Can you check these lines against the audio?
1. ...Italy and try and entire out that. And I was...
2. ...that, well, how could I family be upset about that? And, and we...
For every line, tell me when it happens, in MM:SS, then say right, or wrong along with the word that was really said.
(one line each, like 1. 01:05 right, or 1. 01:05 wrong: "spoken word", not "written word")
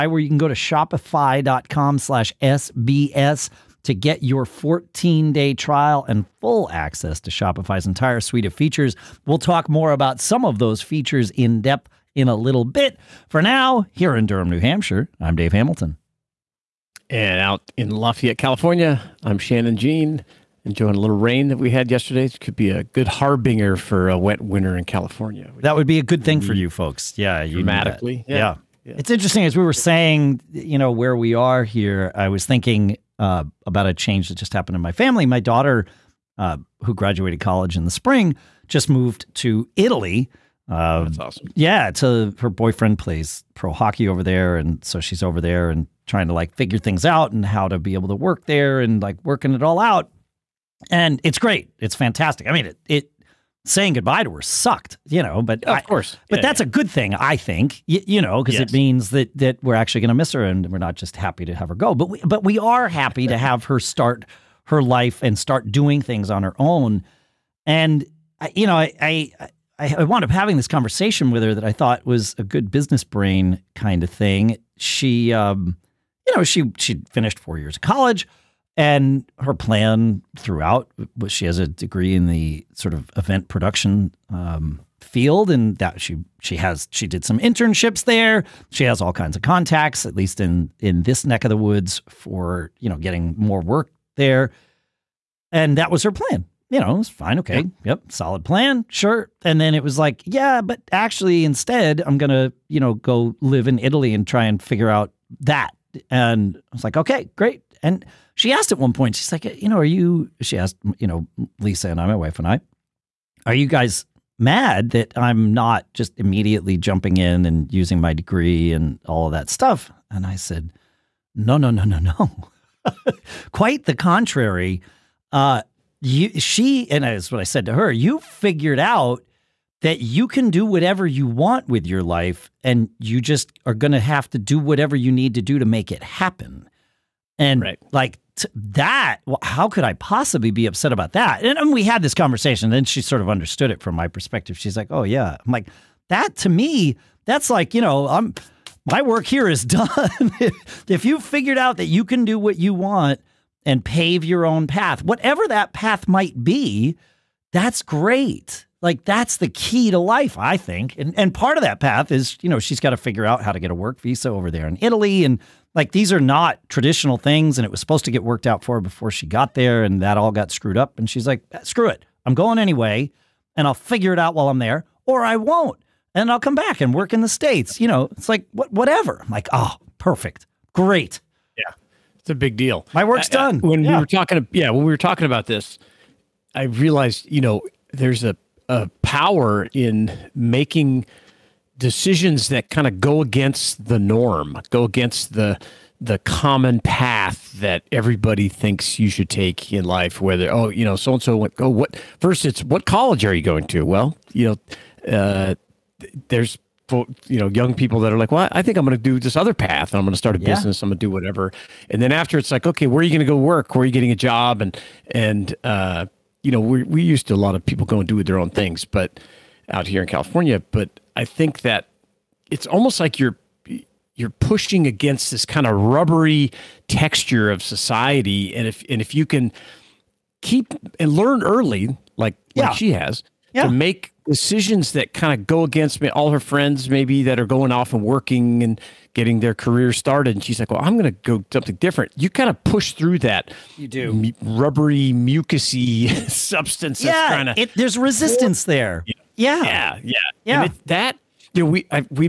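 1. 01:43 wrong: "figure", not "entire"
2. 02:18 wrong: "possibly", not "family".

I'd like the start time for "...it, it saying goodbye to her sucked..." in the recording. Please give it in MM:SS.
00:52.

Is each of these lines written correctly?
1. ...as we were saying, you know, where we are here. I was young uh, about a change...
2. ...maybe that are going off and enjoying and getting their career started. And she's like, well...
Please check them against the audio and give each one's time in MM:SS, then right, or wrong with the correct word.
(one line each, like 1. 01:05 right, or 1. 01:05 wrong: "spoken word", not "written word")
1. 00:29 wrong: "thinking", not "young"
2. 03:56 wrong: "working", not "enjoying".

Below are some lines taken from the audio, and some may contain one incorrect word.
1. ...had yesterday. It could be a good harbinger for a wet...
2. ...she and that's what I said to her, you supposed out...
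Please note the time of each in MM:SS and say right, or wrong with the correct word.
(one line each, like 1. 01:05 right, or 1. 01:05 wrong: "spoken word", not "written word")
1. 00:21 right
2. 02:06 wrong: "figured", not "supposed".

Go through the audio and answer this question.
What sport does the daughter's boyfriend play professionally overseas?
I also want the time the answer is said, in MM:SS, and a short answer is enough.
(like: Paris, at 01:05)
Hockey, at 00:43.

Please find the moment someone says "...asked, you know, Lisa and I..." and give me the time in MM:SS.
01:50.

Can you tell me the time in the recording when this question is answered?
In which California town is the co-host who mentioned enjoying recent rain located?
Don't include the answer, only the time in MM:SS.
00:17.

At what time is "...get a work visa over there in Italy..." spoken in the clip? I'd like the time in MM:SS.
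02:43.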